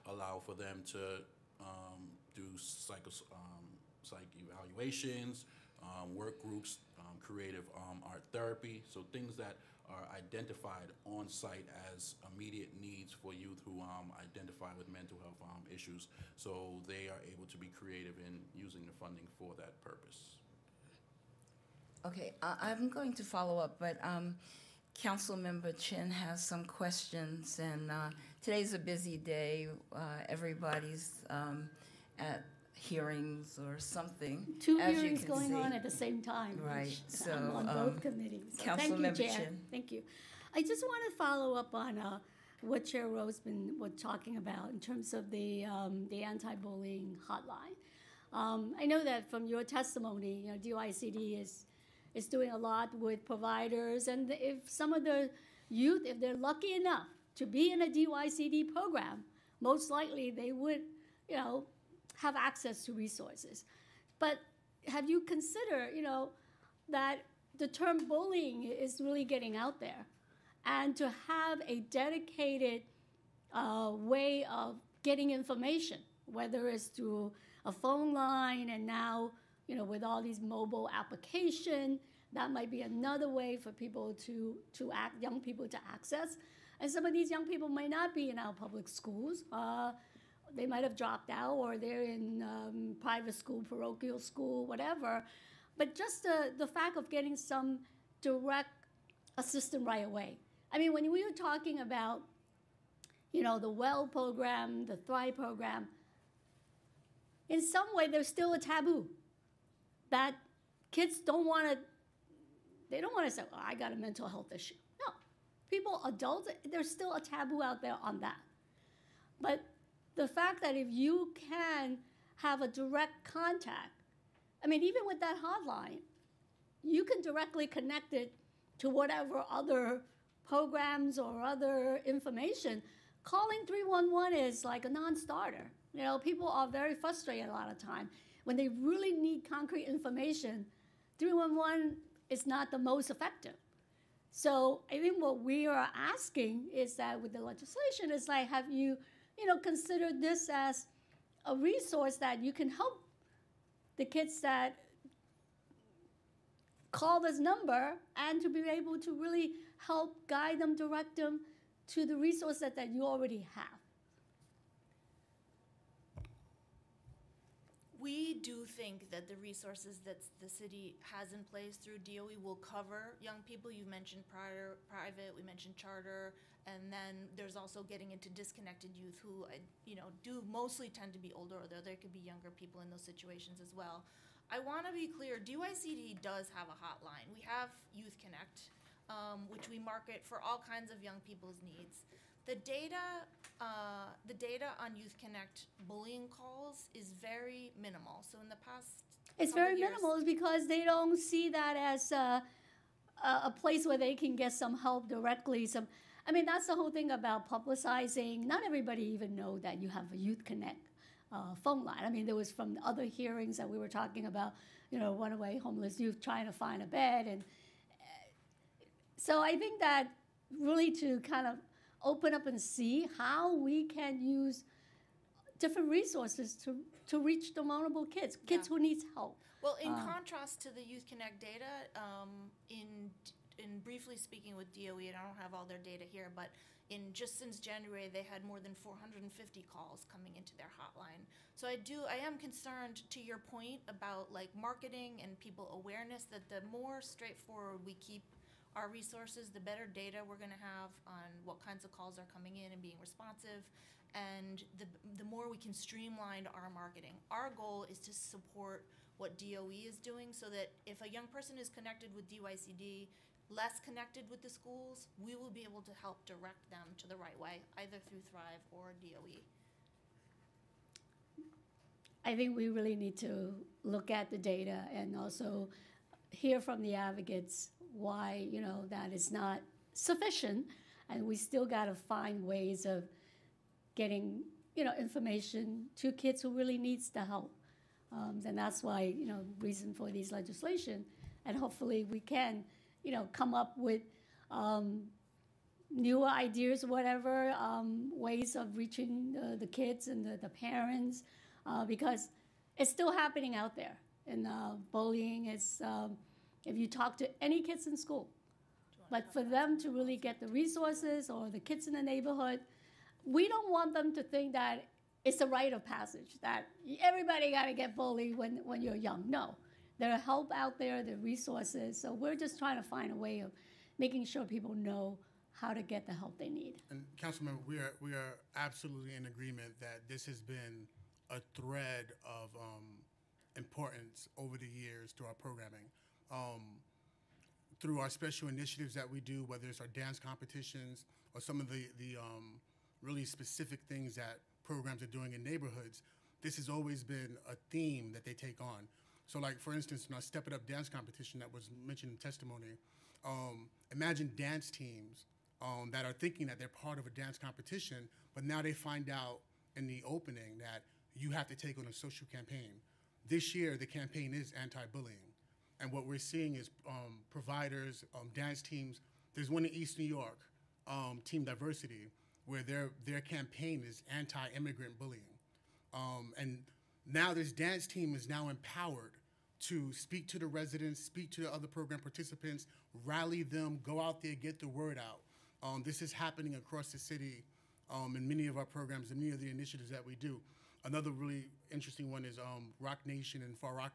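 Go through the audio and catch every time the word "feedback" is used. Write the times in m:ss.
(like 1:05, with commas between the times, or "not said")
not said.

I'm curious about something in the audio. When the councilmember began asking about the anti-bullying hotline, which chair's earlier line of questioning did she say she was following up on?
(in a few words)
Roseman.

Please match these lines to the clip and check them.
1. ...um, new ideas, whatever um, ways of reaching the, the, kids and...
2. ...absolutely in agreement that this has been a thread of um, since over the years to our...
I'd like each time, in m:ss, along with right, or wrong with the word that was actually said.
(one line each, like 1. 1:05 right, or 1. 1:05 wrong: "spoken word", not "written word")
1. 4:54 right
2. 5:28 wrong: "importance", not "since".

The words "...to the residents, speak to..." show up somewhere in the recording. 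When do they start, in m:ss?
6:20.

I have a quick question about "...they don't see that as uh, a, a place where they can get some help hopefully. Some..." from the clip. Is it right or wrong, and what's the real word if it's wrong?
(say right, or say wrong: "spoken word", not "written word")
wrong: "directly", not "hopefully".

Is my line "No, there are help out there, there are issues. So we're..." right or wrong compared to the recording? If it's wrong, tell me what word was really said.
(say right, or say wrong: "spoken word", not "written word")
wrong: "resources", not "issues".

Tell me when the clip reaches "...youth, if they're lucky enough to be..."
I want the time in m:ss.
0:55.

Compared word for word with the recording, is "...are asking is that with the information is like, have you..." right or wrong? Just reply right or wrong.
wrong.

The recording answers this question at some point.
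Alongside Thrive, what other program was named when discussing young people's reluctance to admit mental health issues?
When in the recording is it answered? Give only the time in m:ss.
1:43.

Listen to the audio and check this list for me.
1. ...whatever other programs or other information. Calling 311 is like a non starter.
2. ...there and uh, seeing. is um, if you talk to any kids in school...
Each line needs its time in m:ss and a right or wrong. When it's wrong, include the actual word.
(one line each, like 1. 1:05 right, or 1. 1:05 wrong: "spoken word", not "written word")
1. 2:08 right
2. 5:03 wrong: "bullying", not "seeing".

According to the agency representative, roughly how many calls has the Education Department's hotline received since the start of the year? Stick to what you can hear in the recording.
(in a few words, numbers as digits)
more than 450.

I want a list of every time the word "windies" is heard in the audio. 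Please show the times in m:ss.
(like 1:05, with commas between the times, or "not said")
not said.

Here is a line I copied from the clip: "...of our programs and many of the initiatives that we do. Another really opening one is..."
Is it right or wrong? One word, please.
wrong.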